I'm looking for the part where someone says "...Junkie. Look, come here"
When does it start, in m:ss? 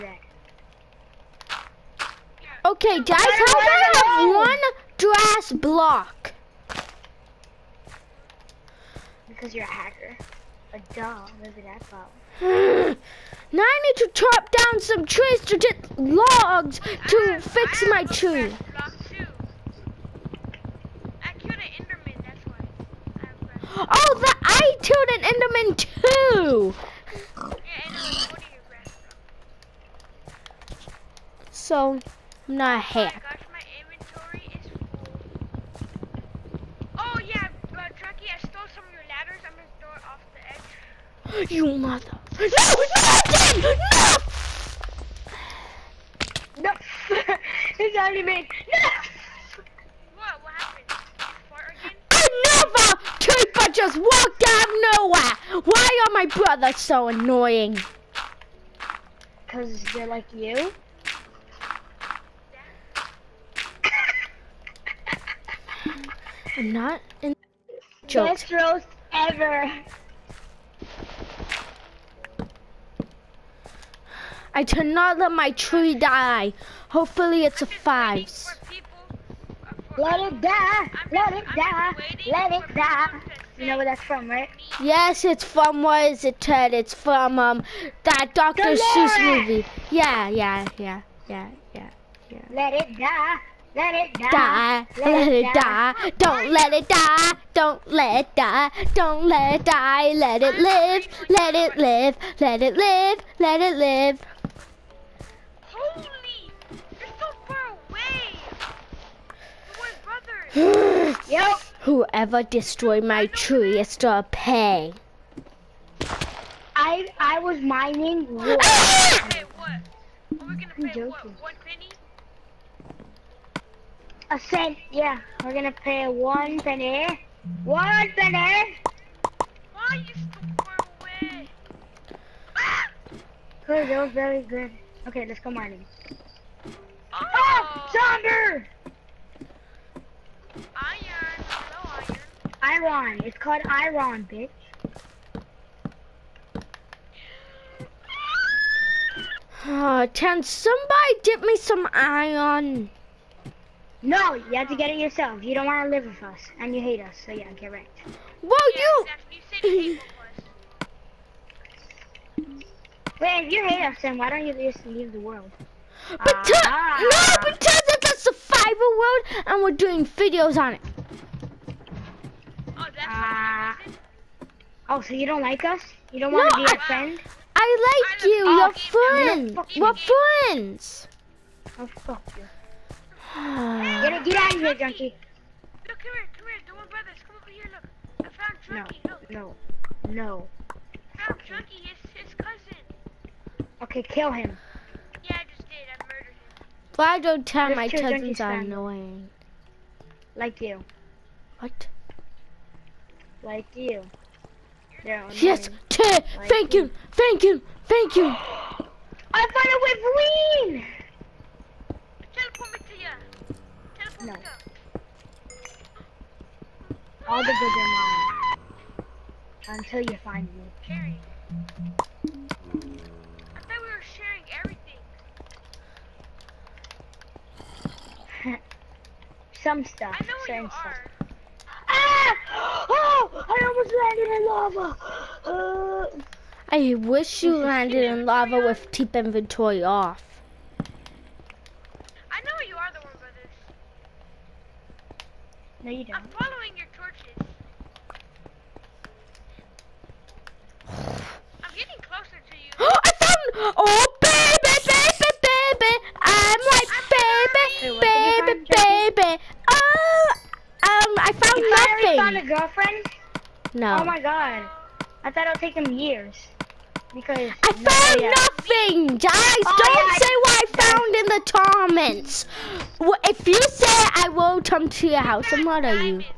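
3:04.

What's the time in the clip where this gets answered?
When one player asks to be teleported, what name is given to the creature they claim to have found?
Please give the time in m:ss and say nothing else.
3:30.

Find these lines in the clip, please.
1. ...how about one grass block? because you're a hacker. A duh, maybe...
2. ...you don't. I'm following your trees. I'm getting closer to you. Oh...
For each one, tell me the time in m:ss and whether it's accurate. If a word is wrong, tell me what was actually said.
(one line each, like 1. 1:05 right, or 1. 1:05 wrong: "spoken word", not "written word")
1. 0:03 right
2. 4:05 wrong: "torches", not "trees".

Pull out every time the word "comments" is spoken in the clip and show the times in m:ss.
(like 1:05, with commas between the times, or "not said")
4:32.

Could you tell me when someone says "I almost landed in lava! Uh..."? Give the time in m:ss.
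3:53.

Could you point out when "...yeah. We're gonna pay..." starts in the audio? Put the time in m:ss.
2:04.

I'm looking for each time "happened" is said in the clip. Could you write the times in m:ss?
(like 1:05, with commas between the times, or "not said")
0:50.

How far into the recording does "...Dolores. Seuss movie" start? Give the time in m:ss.
1:28.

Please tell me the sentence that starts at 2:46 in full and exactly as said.
But Uh, no, but survival world and we're doing videos on it.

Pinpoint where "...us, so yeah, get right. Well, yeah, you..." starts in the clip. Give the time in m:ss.
2:37.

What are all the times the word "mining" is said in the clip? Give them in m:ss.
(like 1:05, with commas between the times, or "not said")
1:57, 2:15.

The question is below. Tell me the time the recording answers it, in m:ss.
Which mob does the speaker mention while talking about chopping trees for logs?
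0:25.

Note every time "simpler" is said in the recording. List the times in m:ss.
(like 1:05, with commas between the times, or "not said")
not said.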